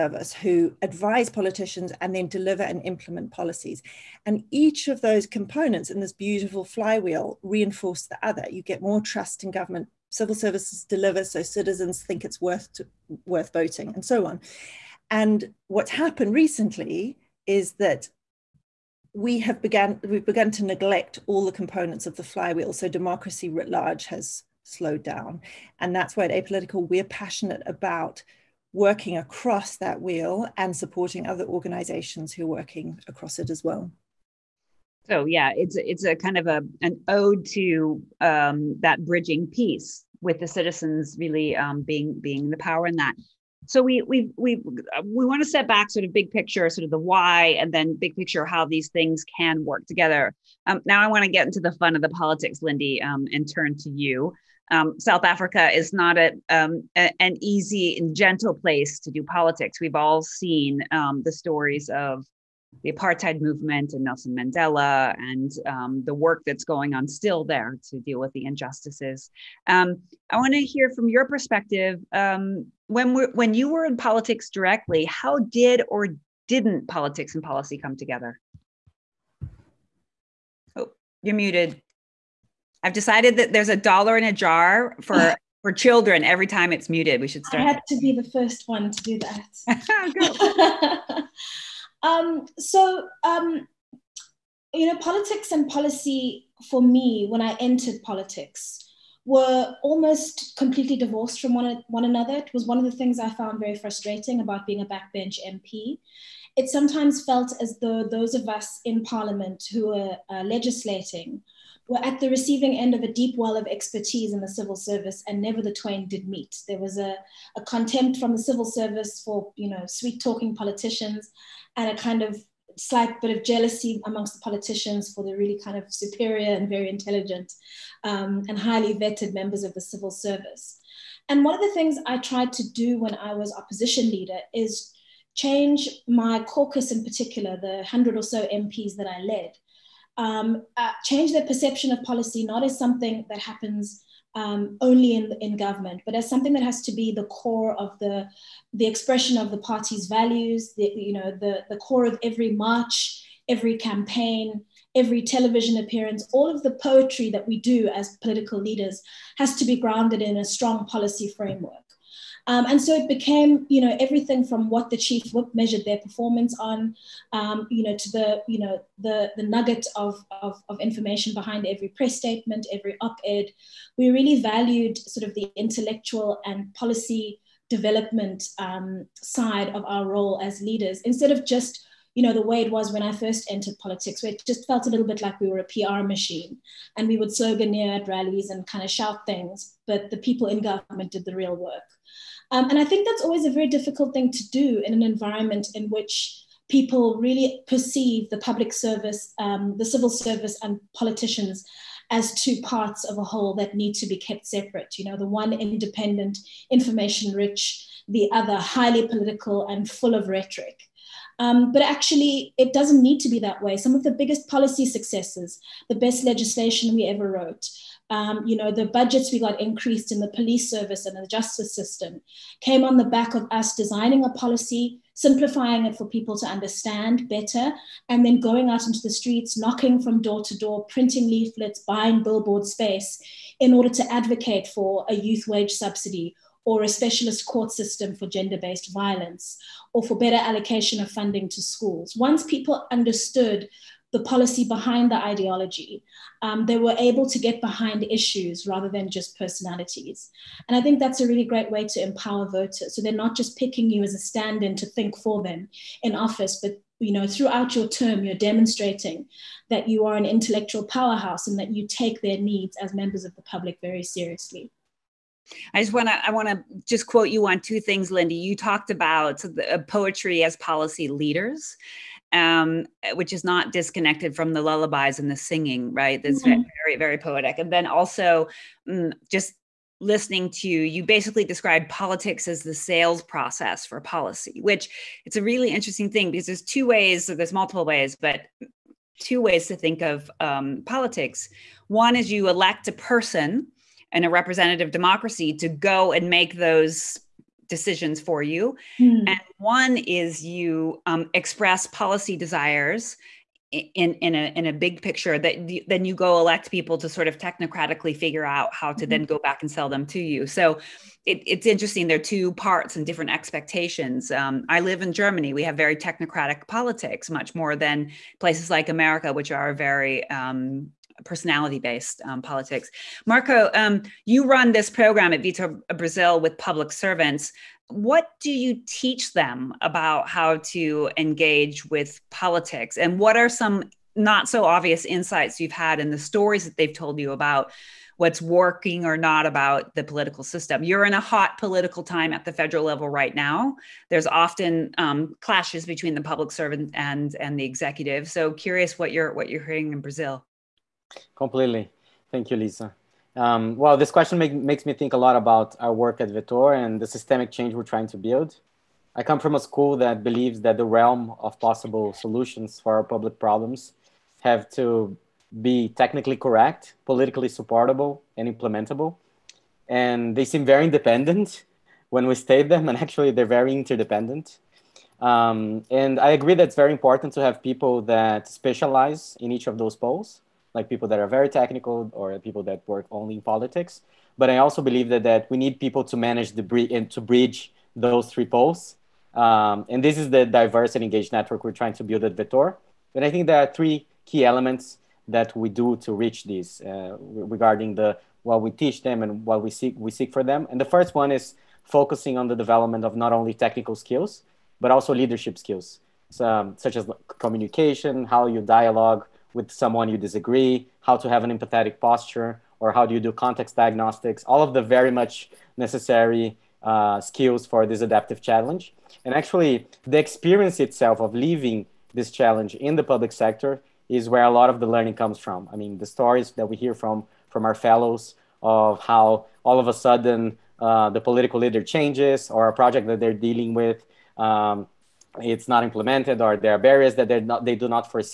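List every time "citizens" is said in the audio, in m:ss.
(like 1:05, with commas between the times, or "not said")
0:11, 0:40.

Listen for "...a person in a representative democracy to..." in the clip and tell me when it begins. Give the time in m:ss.
4:52.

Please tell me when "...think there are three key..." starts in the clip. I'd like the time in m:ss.
6:33.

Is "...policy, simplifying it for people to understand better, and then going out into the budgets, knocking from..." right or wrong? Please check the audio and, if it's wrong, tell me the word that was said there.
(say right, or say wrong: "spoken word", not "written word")
wrong: "streets", not "budgets".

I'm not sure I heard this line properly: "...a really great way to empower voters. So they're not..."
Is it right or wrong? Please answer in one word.
right.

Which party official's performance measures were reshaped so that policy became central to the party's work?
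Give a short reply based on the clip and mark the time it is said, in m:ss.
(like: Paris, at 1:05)
chief whip, at 2:44.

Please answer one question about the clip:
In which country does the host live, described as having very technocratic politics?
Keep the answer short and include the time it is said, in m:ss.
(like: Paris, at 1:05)
Germany, at 5:15.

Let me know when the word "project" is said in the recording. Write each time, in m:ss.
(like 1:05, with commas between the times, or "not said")
7:12.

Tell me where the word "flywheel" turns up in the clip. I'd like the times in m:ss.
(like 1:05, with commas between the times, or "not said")
0:06, 0:22.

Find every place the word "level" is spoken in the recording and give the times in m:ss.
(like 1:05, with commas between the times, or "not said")
5:42.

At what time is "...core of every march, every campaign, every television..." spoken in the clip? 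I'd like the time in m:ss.
2:31.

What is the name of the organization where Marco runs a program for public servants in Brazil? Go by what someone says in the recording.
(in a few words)
Vetor Brasil.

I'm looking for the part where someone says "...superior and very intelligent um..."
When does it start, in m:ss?
2:05.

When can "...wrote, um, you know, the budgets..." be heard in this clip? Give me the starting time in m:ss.
3:37.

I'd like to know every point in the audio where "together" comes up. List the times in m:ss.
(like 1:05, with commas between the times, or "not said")
0:49, 1:17.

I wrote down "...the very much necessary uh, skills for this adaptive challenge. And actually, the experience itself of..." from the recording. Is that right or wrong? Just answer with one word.
right.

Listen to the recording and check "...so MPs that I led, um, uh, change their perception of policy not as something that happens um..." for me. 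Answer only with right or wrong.
right.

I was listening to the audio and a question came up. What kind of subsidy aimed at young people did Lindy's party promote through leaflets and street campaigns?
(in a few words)
youth wage subsidy.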